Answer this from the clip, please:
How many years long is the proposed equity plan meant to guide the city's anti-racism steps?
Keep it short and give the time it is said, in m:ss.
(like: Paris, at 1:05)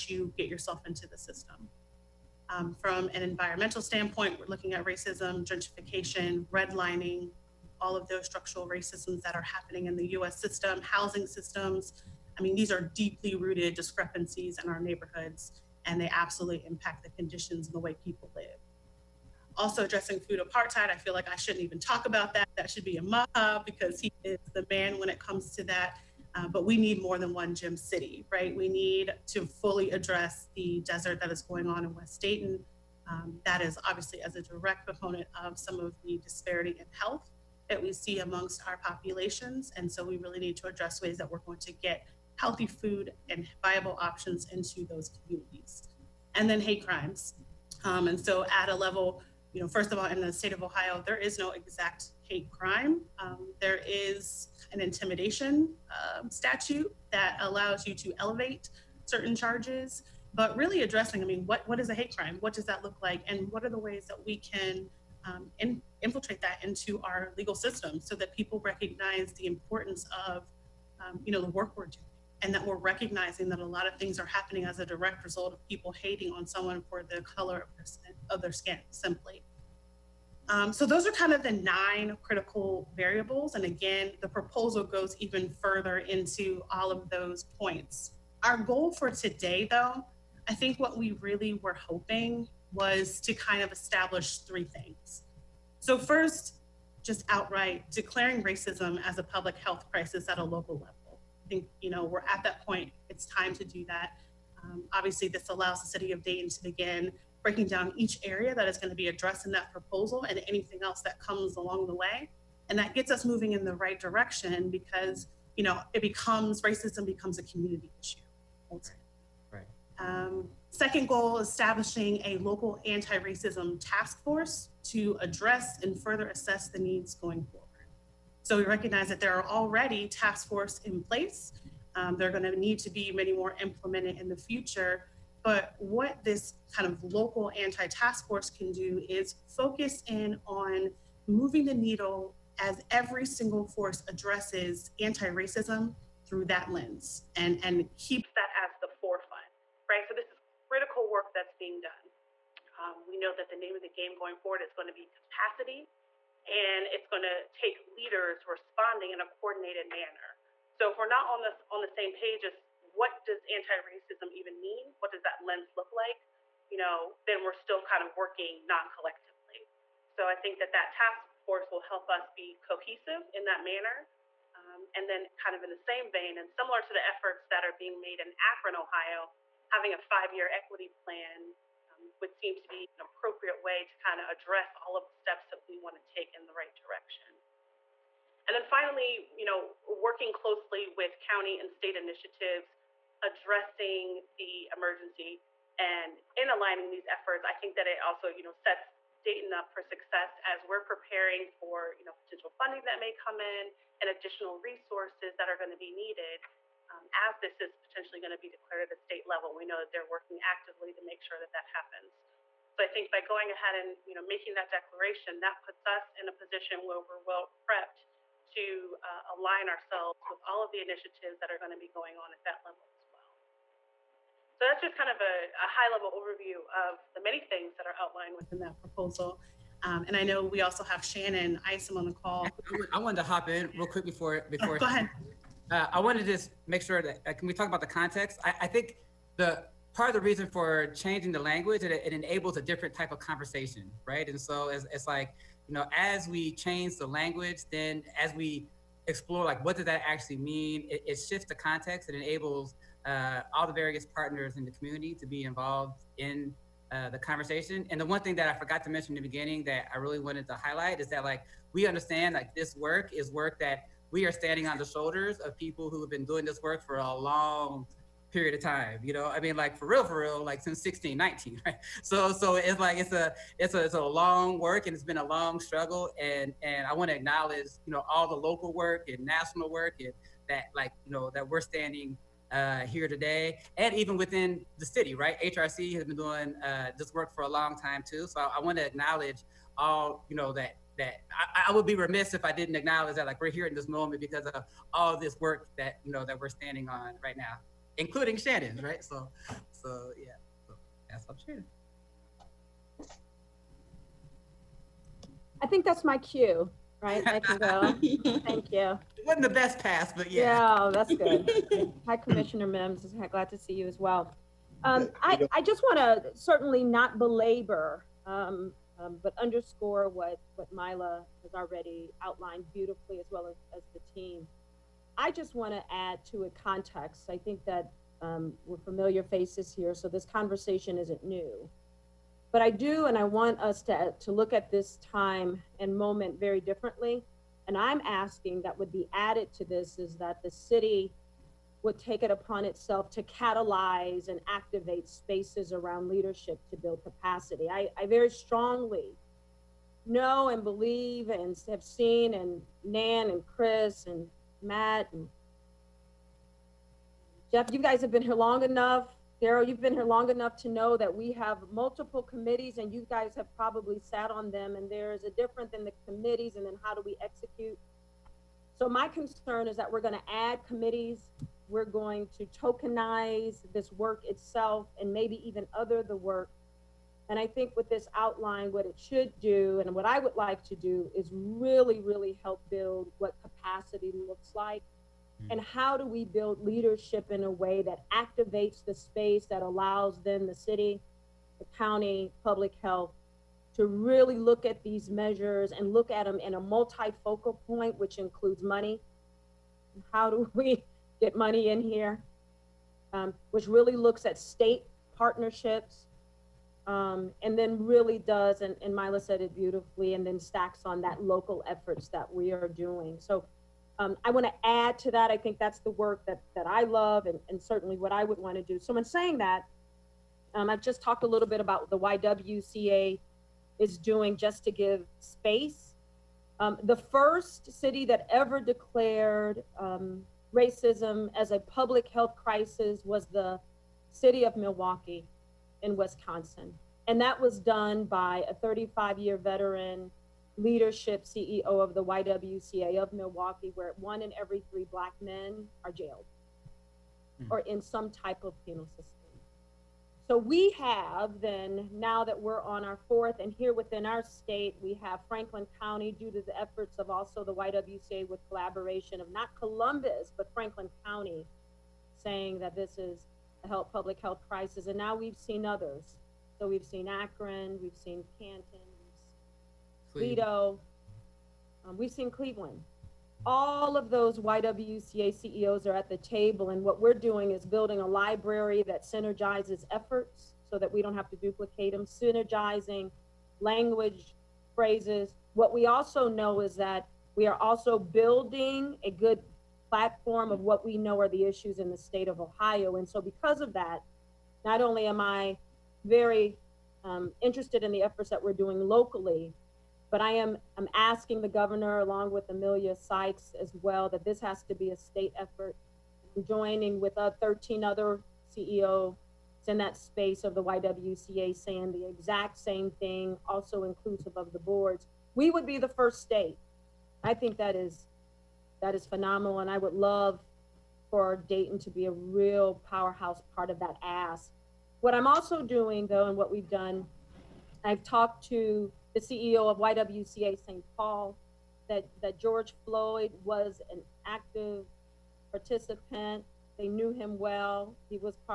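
5, at 2:59.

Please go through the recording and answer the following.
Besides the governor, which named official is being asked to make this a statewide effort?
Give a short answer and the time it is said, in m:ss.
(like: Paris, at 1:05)
Emilia Sykes, at 8:22.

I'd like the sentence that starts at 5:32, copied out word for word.
But I do, and I want us to, to look at this time and moment very differently.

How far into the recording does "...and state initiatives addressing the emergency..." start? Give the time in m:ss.
3:11.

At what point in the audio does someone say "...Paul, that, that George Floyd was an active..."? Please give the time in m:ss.
8:50.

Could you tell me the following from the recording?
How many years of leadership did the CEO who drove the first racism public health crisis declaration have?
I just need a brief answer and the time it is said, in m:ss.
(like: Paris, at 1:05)
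35, at 7:18.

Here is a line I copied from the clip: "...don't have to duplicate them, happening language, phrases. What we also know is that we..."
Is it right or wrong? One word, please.
wrong.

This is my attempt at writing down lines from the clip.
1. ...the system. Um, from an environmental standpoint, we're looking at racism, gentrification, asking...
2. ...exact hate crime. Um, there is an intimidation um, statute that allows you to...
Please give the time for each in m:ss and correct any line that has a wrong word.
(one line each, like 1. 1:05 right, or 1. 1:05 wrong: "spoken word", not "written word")
1. 0:01 wrong: "redlining", not "asking"
2. 0:51 right.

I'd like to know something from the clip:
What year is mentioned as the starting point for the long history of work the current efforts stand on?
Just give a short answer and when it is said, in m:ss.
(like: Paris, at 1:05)
1619, at 4:30.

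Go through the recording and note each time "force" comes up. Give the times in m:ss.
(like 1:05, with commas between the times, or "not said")
2:04, 2:10, 2:18, 2:23, 2:51.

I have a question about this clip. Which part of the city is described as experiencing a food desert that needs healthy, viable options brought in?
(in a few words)
West Dayton.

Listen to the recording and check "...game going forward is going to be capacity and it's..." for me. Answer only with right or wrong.
right.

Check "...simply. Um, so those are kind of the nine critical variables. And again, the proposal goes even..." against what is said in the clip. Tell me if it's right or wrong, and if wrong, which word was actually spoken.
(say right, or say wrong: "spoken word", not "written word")
right.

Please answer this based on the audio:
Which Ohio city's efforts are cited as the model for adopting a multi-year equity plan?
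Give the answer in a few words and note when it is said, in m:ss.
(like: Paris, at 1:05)
Akron, Ohio, at 2:58.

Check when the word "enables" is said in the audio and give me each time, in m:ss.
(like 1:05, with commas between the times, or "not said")
4:02, 4:12.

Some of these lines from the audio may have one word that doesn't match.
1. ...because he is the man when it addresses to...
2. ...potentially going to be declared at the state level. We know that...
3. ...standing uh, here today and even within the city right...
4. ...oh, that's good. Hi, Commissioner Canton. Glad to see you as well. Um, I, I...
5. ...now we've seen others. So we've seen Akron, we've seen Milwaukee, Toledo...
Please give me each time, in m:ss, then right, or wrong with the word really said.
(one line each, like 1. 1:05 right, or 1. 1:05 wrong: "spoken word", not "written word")
1. 0:23 wrong: "comes", not "addresses"
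2. 3:27 right
3. 4:41 right
4. 5:10 wrong: "Mims", not "Canton"
5. 7:44 wrong: "Canton", not "Milwaukee".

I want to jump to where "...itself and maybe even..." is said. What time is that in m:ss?
6:14.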